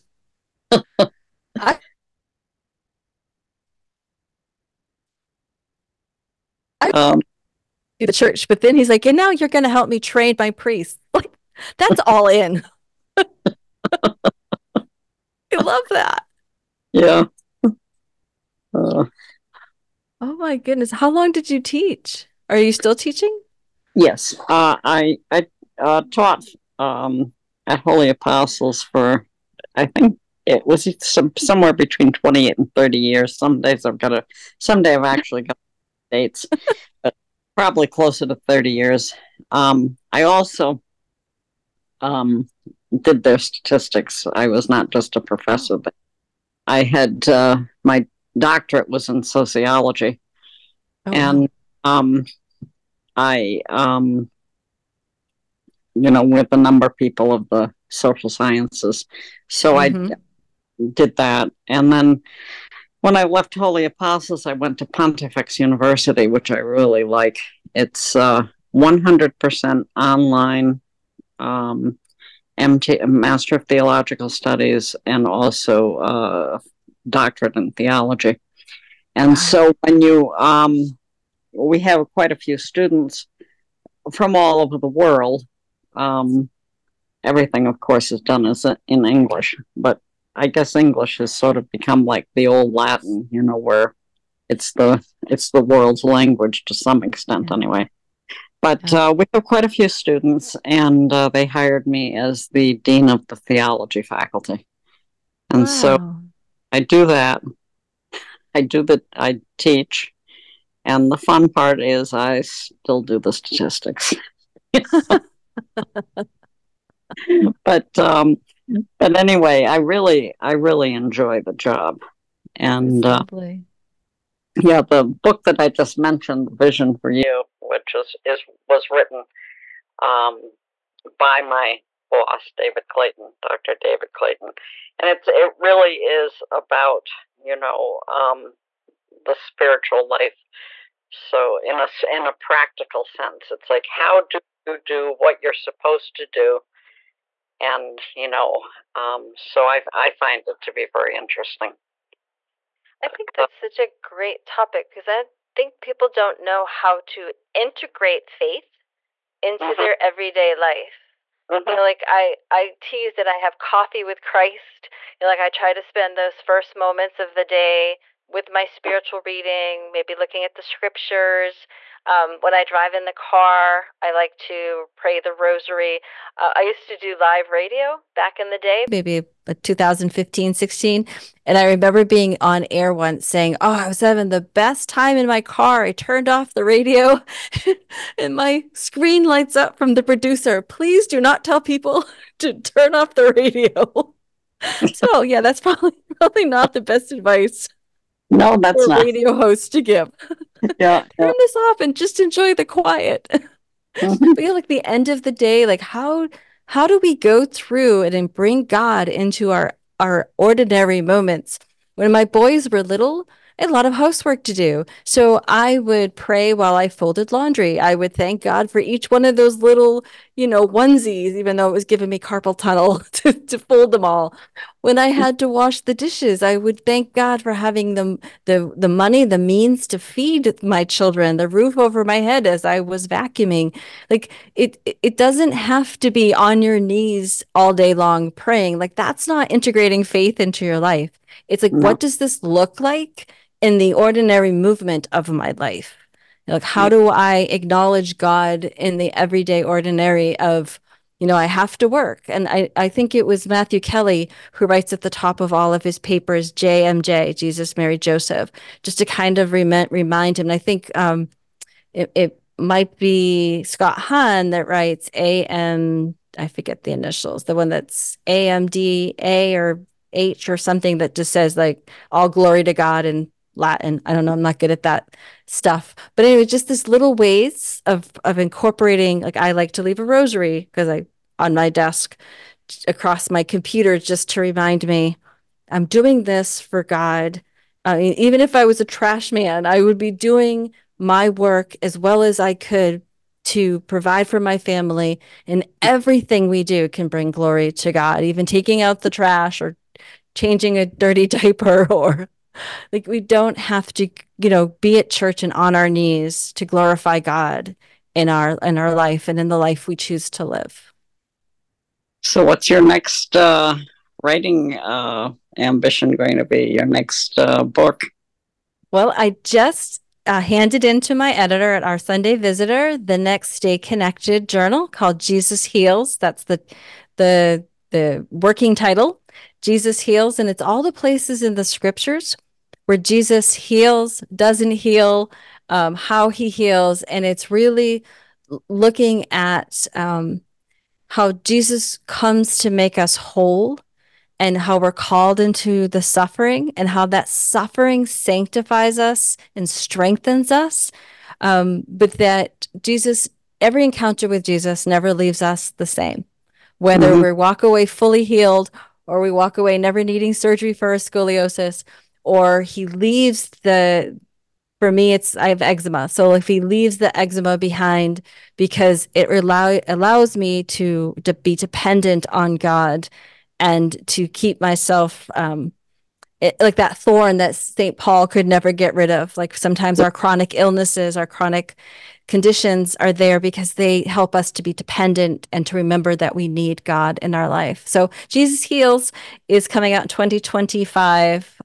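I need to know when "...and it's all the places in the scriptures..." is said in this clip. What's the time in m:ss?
5:30.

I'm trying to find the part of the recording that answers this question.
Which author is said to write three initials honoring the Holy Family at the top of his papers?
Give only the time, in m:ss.
4:13.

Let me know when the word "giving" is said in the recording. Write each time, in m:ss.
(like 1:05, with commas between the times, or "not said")
3:41.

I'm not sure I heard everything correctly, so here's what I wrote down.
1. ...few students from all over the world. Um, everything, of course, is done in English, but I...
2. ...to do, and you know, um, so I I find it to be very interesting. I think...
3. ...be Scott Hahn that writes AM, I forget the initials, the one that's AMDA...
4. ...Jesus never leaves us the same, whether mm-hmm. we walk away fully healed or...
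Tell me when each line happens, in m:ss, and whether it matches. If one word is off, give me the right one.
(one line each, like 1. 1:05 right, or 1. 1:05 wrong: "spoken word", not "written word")
1. 1:22 right
2. 2:26 right
3. 4:22 right
4. 5:54 right.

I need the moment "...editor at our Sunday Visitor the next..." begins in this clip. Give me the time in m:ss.
5:21.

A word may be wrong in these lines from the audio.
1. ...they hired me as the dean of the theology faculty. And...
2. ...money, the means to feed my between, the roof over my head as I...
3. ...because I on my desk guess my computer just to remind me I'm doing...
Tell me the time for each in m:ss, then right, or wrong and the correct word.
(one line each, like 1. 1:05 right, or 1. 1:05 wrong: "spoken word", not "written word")
1. 1:41 right
2. 3:48 wrong: "children", not "between"
3. 4:40 wrong: "across", not "guess".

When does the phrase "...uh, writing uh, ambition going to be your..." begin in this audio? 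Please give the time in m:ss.
5:13.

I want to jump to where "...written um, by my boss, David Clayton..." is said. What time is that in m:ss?
2:08.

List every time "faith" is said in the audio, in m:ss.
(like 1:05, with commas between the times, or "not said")
2:38, 4:00.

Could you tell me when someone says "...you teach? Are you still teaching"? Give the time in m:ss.
0:21.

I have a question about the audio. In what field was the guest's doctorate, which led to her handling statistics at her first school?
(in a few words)
Sociology.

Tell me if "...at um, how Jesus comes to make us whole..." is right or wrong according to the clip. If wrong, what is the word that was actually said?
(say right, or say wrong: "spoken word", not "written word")
right.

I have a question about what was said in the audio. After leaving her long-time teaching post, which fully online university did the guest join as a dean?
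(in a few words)
Pontifex University.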